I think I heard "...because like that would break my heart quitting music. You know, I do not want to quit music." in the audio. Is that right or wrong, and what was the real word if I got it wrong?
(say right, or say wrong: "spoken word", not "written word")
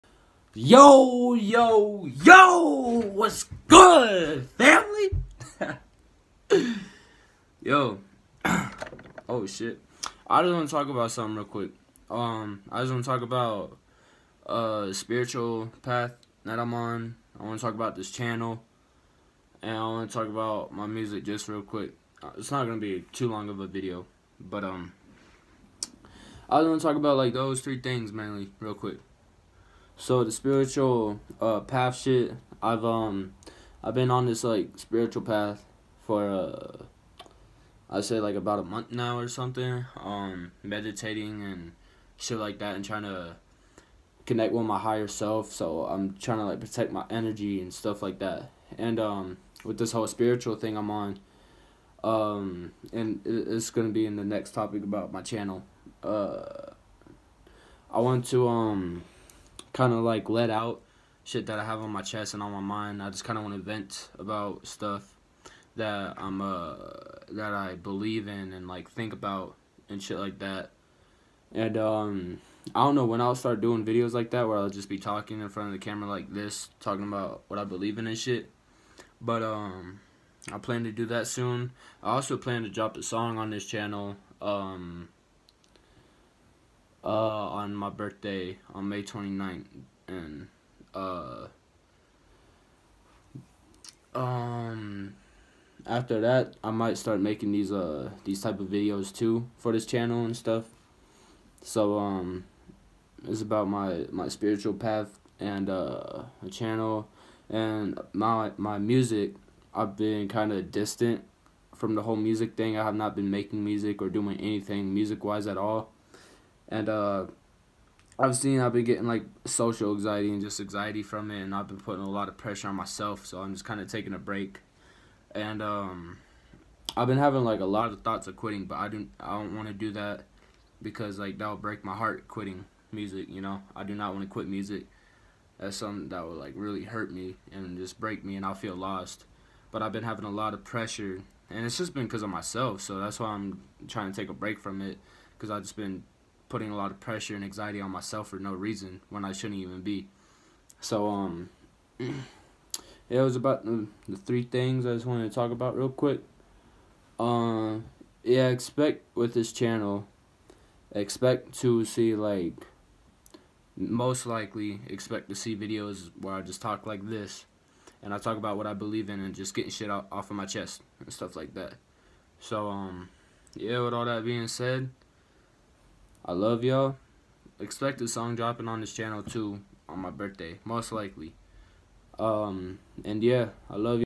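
right.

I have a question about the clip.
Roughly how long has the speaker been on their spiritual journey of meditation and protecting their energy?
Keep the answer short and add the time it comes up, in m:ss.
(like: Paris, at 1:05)
about a month, at 0:38.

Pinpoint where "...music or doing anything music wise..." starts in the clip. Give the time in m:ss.
1:53.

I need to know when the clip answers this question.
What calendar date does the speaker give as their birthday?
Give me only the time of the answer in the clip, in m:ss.
1:28.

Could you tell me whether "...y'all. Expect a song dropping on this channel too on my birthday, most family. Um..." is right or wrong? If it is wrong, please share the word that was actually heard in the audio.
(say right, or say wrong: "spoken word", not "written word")
wrong: "likely", not "family".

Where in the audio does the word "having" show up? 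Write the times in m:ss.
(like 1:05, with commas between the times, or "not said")
2:07, 2:20.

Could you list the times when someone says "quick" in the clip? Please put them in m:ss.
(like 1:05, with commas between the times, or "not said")
0:11, 0:21, 0:28, 2:35.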